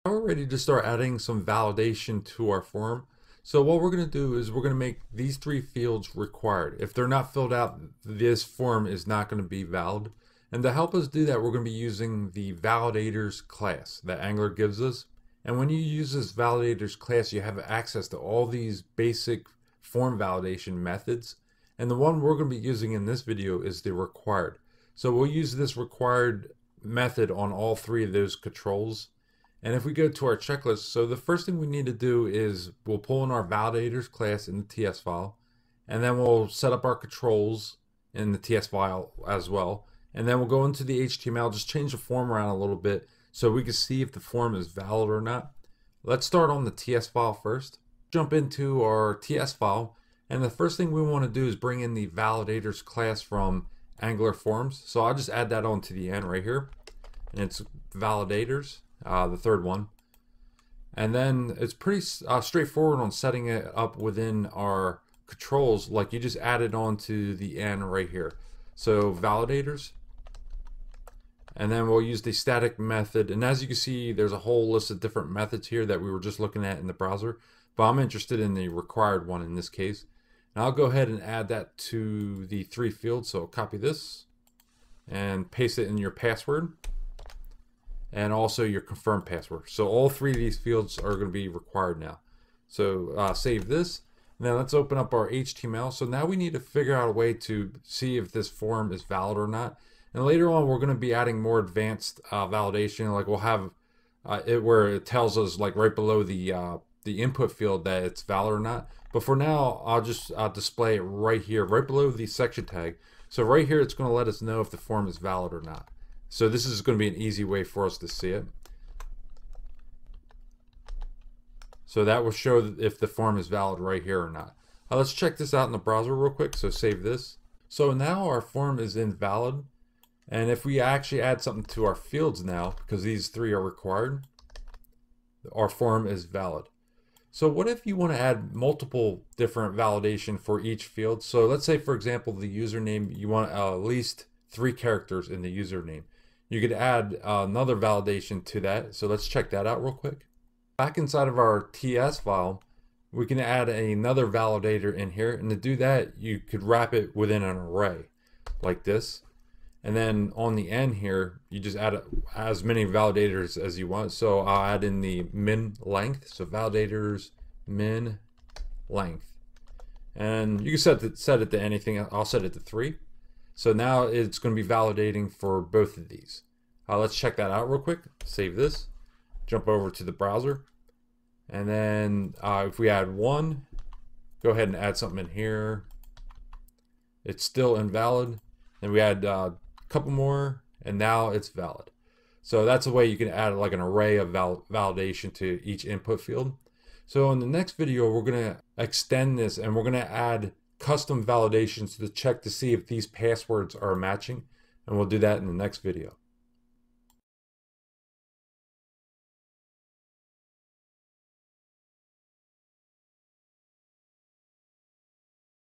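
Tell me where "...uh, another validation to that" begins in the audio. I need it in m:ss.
2:27.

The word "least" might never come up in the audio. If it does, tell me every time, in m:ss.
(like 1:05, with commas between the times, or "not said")
2:23.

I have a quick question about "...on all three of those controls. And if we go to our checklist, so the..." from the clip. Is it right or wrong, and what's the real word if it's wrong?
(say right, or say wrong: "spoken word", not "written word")
right.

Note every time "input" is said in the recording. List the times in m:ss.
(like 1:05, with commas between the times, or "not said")
1:47, 3:15.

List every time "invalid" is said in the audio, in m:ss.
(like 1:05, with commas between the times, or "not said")
2:08, 3:07.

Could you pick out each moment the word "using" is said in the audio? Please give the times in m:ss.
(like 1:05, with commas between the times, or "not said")
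0:11, 0:22.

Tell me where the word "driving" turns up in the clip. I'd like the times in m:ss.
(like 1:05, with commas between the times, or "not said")
not said.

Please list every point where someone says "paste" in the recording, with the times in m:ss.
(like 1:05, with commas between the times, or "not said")
1:25.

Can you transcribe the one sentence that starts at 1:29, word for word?
So all three of these fields are going to be required now.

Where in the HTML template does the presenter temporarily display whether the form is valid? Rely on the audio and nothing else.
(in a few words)
below the section tag.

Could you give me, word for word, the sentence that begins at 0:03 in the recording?
So what we're going to do is we're going to make these three fields required.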